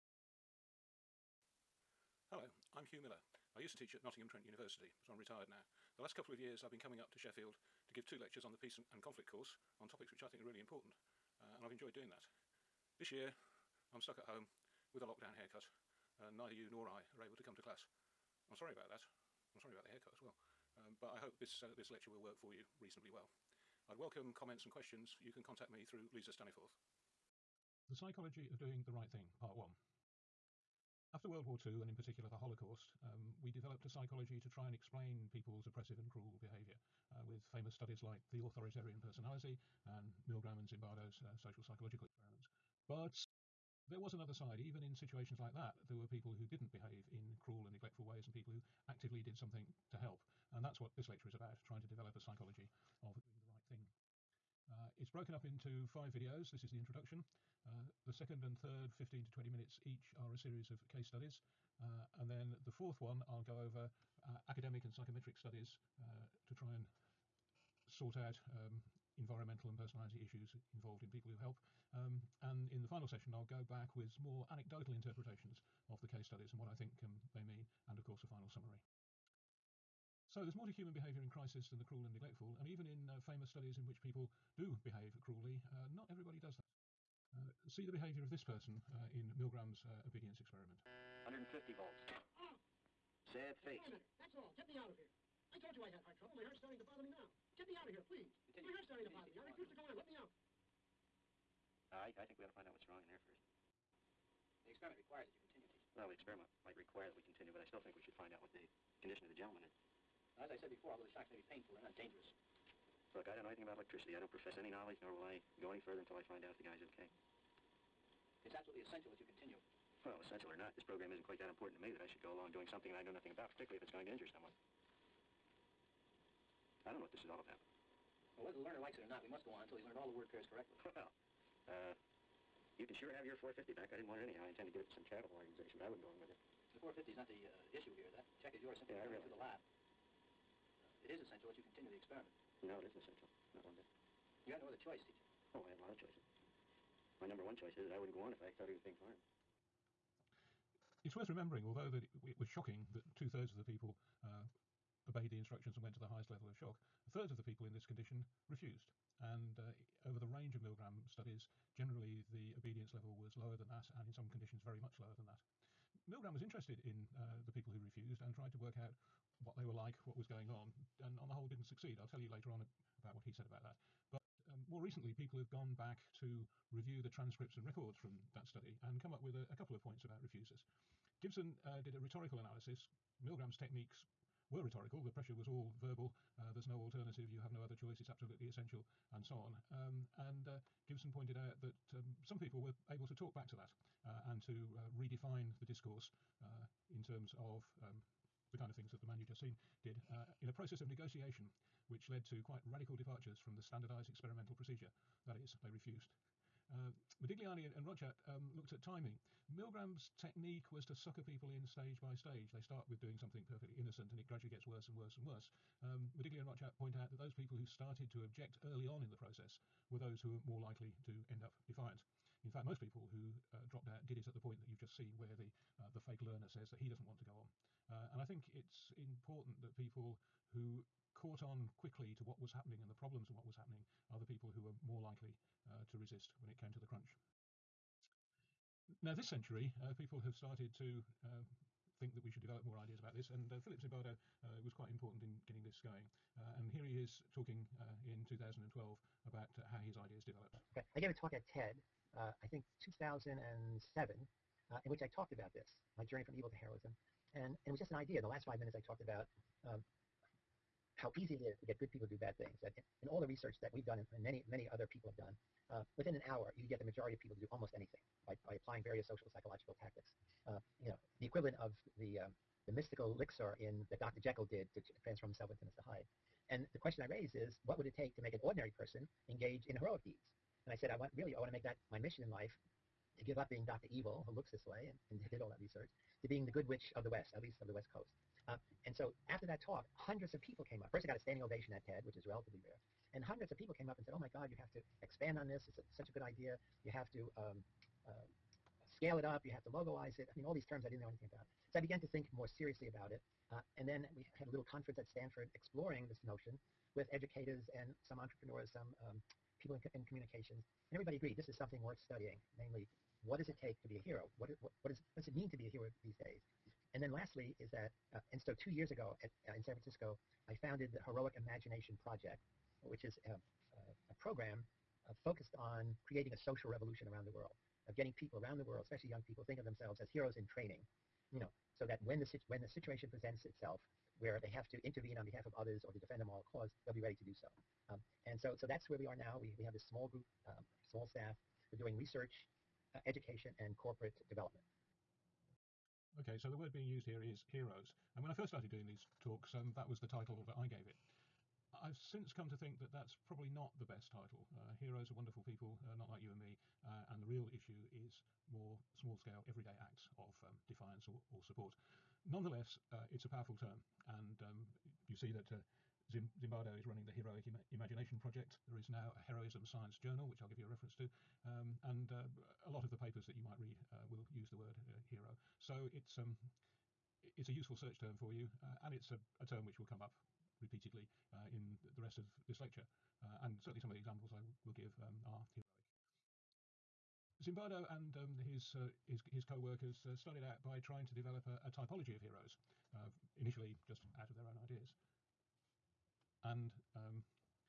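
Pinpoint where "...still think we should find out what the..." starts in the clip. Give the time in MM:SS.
01:47.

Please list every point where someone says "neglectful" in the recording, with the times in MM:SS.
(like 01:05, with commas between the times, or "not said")
00:47, 01:22.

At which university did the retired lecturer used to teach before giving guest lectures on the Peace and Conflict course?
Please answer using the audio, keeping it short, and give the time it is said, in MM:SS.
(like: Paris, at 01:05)
Nottingham Trent University, at 00:04.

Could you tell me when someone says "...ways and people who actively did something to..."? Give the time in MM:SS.
00:48.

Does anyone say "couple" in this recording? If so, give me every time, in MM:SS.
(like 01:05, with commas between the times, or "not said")
00:06, 02:59.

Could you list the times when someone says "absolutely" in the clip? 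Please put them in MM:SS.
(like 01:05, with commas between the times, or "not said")
01:58, 03:08.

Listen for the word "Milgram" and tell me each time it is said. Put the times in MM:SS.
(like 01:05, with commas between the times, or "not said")
00:40, 01:29, 02:40, 02:46, 03:03, 03:29.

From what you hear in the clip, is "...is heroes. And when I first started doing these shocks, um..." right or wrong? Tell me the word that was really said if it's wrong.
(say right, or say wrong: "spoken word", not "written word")
wrong: "talks", not "shocks".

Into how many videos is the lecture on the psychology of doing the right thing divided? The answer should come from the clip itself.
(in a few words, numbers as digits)
5.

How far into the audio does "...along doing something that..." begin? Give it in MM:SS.
02:02.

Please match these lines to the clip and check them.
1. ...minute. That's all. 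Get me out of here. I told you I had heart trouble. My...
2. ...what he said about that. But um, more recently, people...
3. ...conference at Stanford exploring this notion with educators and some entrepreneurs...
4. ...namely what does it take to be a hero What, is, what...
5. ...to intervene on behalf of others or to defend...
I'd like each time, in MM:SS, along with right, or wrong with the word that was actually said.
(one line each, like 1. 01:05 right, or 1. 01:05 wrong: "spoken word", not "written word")
1. 01:33 right
2. 02:53 right
3. 05:04 right
4. 05:12 right
5. 05:34 right.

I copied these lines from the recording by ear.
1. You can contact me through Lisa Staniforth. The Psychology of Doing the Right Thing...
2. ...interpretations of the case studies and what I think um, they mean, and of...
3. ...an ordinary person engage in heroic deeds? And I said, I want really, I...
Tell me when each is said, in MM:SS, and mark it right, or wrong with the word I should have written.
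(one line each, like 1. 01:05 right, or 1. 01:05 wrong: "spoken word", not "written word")
1. 00:25 right
2. 01:14 right
3. 04:38 right.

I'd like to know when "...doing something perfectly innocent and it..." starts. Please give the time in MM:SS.
03:32.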